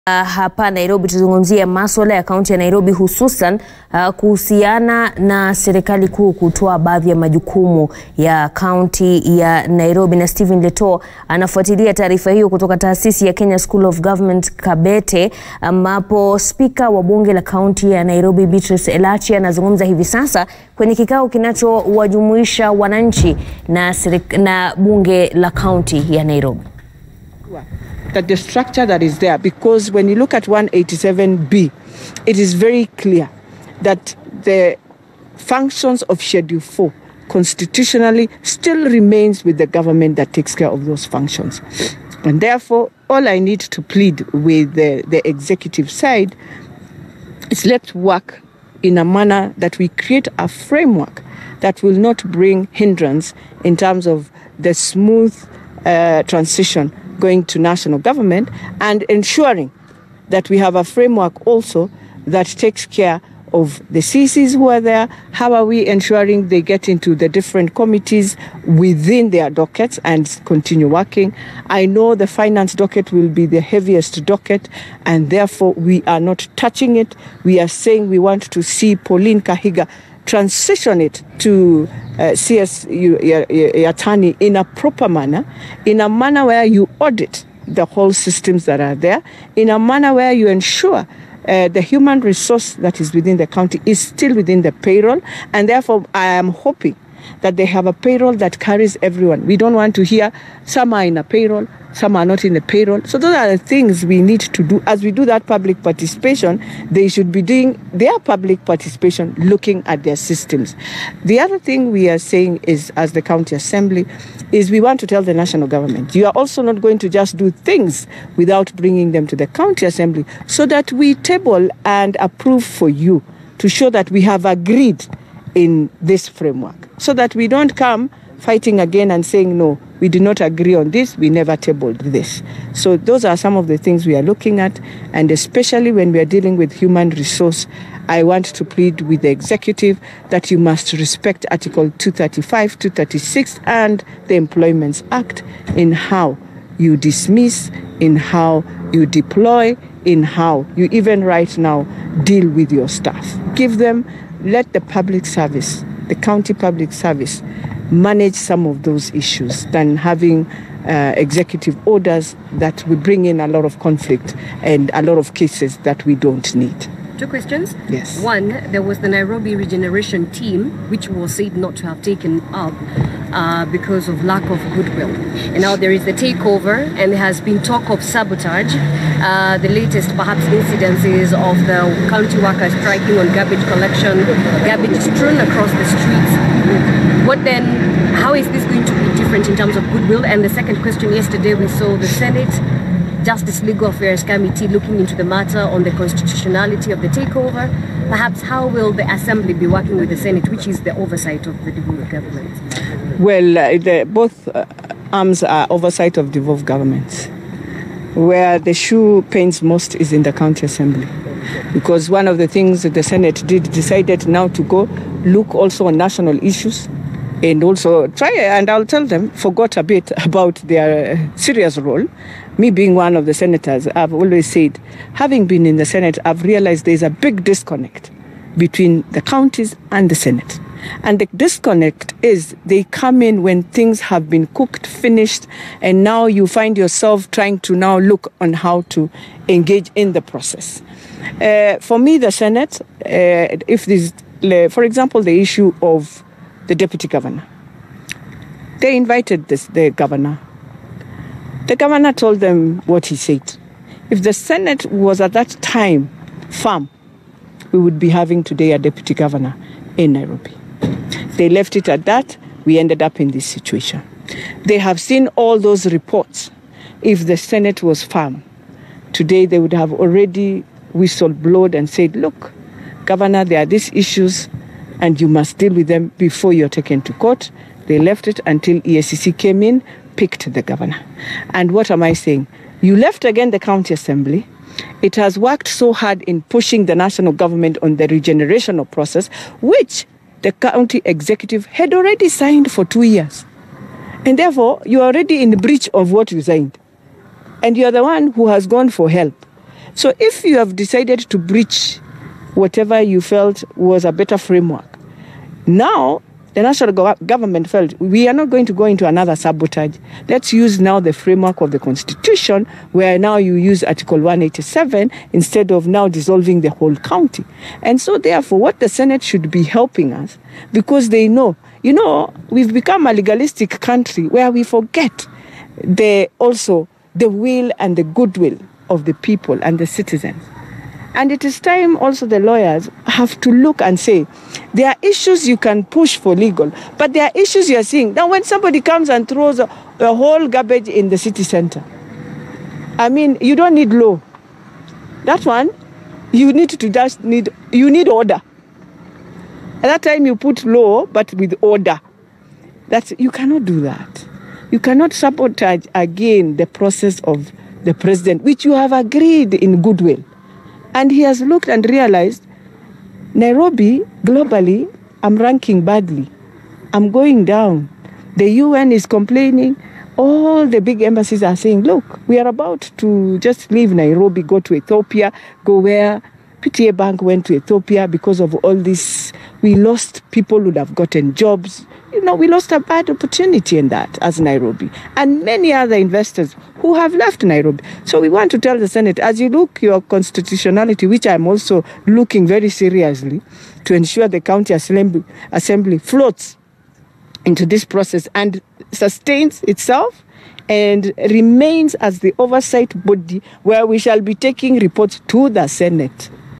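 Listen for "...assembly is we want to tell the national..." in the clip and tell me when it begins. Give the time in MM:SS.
01:53.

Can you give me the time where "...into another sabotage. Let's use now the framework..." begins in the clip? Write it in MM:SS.
05:08.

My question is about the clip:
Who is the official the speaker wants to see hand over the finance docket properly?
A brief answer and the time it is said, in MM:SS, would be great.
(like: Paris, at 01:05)
Pauline Kahiga, at 01:18.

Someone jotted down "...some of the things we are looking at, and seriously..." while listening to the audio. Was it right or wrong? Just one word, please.
wrong.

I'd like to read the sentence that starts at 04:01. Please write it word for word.
Uh, for me, the Senate, uh, if this, uh, for example, the issue of the deputy governor.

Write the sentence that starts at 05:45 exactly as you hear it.
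That one, you need to just need, you need order.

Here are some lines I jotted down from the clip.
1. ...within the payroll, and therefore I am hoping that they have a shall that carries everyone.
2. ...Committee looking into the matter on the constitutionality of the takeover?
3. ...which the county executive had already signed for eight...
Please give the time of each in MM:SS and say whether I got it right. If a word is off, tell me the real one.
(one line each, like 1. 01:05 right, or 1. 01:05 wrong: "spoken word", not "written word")
1. 01:34 wrong: "payroll", not "shall"
2. 03:14 right
3. 04:49 wrong: "two", not "eight".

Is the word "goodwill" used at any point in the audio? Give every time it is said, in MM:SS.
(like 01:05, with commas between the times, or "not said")
02:54, 03:09, 05:28, 05:59.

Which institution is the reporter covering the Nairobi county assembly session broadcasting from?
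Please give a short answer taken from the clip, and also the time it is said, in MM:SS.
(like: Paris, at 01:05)
Kenya School of Government, at 00:13.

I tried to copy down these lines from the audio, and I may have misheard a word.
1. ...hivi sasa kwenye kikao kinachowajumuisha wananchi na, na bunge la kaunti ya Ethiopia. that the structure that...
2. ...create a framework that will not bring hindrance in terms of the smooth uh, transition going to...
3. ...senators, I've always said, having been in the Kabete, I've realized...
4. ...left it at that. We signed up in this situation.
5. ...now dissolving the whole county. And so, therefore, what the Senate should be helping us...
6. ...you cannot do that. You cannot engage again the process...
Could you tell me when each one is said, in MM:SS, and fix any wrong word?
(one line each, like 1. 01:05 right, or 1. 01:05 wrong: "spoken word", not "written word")
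1. 00:19 wrong: "Nairobi", not "Ethiopia"
2. 00:49 right
3. 03:43 wrong: "Senate", not "Kabete"
4. 04:21 wrong: "ended", not "signed"
5. 05:15 right
6. 05:53 wrong: "sabotage", not "engage".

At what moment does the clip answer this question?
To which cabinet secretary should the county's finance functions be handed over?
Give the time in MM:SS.
01:22.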